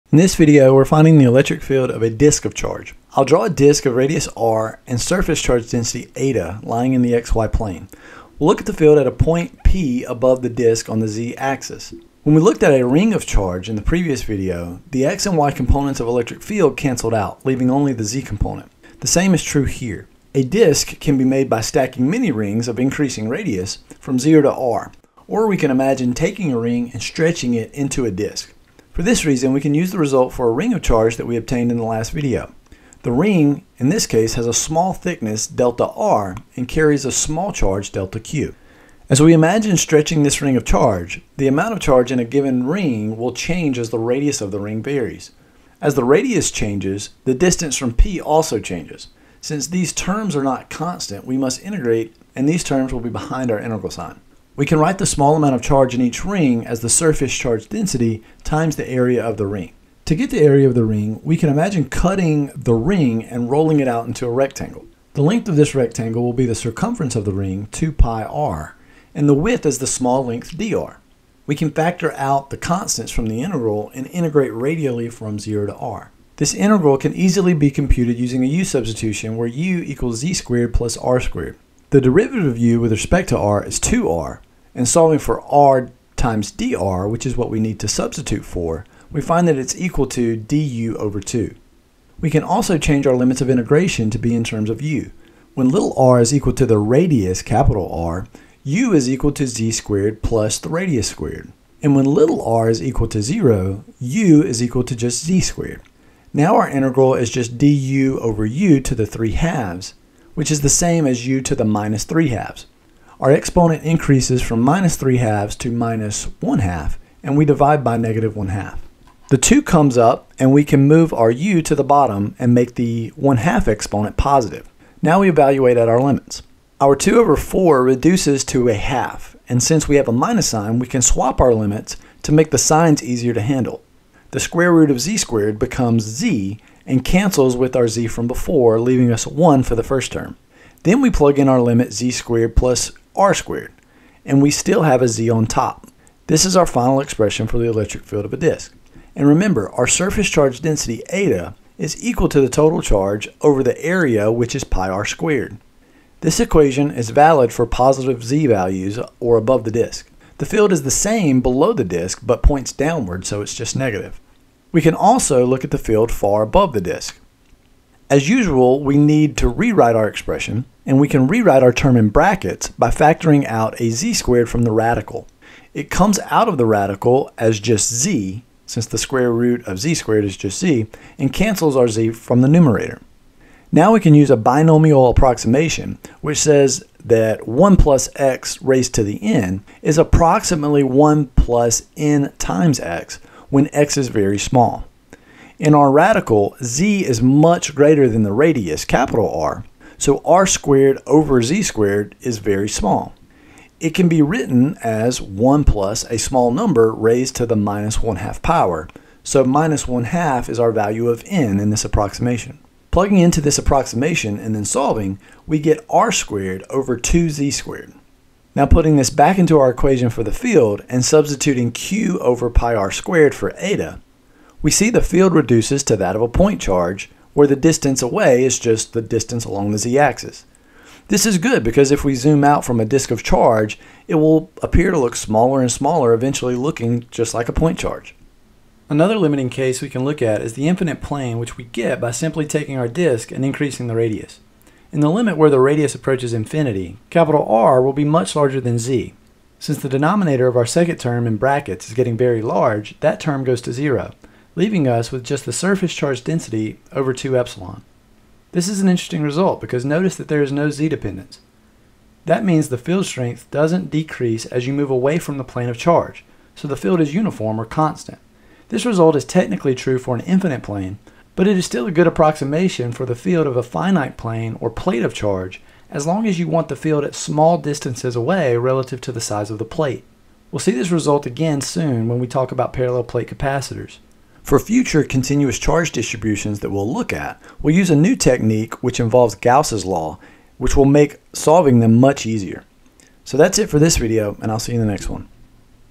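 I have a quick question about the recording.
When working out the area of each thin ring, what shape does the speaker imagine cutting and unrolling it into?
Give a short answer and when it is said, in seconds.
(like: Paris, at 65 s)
A rectangle, at 64 s.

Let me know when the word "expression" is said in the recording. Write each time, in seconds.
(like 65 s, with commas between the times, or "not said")
146 s, 170 s.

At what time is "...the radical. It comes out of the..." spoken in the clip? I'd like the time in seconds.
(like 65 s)
174 s.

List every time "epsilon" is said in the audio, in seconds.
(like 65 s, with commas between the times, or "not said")
257 s.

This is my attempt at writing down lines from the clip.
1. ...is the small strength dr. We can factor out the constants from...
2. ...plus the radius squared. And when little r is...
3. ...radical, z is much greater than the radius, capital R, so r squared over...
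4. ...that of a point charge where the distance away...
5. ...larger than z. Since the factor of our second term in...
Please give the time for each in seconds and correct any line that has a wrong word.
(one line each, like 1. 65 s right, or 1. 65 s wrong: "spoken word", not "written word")
1. 69 s wrong: "length", not "strength"
2. 100 s right
3. 195 s right
4. 225 s right
5. 248 s wrong: "denominator", not "factor".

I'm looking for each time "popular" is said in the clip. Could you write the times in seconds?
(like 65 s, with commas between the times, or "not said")
not said.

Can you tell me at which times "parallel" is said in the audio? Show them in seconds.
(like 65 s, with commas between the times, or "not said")
282 s.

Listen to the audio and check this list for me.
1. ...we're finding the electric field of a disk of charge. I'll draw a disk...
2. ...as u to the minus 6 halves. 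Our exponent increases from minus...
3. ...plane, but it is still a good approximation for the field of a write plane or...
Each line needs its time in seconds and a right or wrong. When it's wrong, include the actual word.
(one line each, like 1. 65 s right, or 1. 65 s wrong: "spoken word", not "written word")
1. 0 s right
2. 111 s wrong: "3", not "6"
3. 270 s wrong: "finite", not "write".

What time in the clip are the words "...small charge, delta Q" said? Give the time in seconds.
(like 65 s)
37 s.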